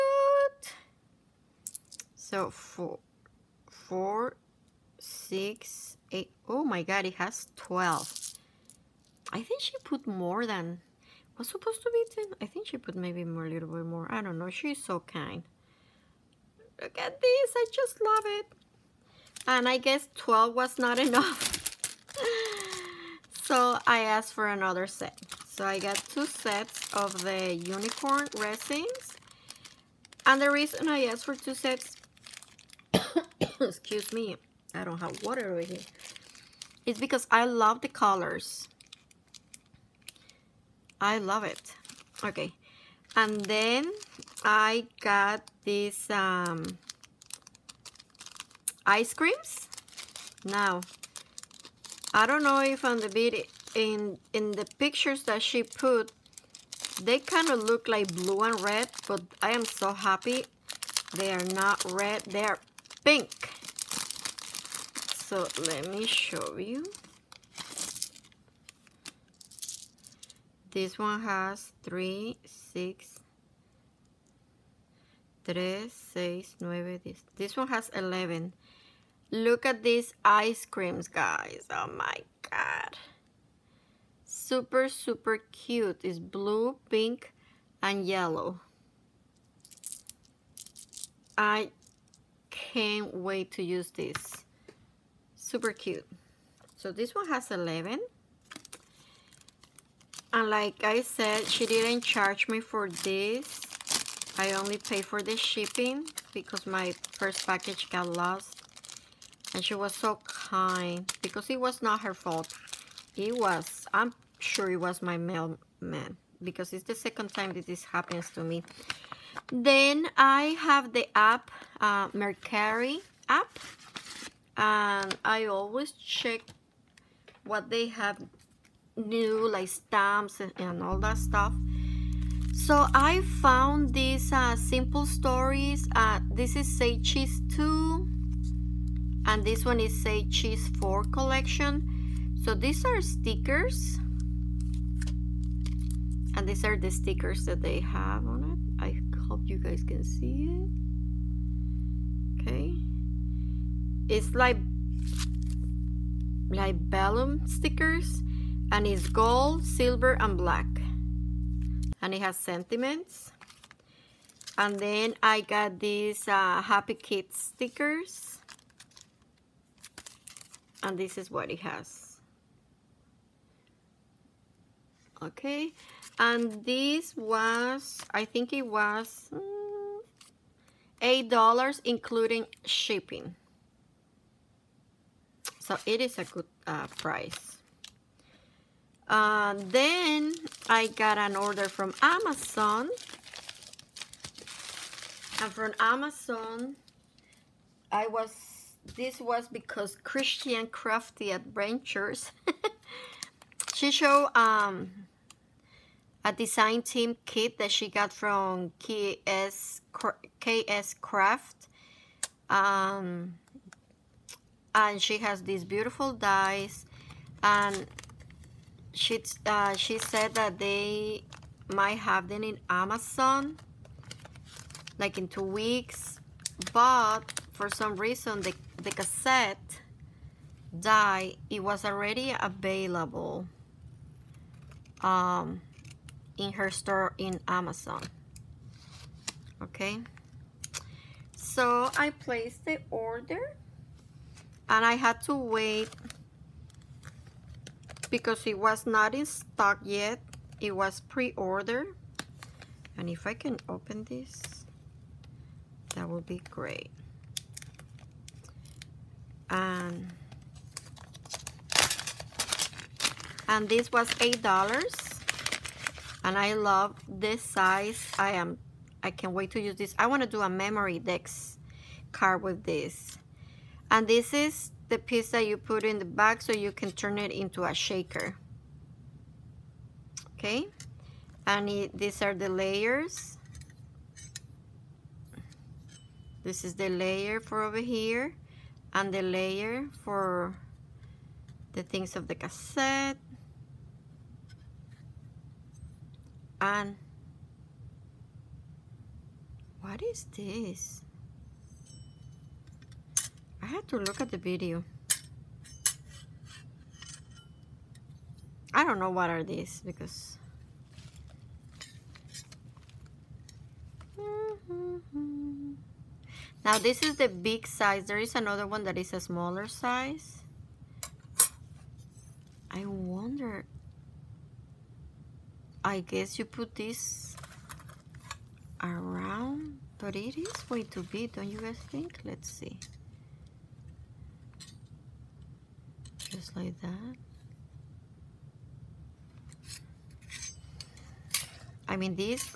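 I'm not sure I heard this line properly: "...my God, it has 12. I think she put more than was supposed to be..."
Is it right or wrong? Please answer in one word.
right.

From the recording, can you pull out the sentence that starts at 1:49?
And she was so kind because it was not her fault.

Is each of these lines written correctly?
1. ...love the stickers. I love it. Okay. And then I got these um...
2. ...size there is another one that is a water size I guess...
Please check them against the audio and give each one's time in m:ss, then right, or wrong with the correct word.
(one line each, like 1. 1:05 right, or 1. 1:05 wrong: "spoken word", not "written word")
1. 0:37 wrong: "colors", not "stickers"
2. 5:17 wrong: "smaller", not "water".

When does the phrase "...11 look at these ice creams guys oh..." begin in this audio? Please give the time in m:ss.
1:17.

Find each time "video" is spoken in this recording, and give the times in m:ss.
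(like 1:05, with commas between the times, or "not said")
0:53, 5:04.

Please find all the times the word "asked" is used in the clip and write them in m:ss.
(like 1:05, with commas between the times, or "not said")
0:23, 0:31.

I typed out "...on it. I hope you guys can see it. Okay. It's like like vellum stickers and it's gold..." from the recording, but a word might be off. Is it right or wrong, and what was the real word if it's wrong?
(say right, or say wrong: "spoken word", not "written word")
right.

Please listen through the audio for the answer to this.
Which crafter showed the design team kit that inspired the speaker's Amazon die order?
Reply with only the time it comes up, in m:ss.
3:20.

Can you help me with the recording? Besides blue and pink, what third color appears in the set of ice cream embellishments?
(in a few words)
Yellow.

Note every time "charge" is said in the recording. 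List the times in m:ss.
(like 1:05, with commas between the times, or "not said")
1:42.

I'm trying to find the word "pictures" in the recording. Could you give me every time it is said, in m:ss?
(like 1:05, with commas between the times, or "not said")
0:54.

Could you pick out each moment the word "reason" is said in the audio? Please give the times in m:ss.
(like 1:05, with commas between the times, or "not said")
0:30, 3:47.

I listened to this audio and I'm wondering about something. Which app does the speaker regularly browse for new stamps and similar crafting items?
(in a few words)
Mercari.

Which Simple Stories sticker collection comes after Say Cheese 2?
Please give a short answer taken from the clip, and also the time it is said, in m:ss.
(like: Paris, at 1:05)
Say Cheese 4, at 2:19.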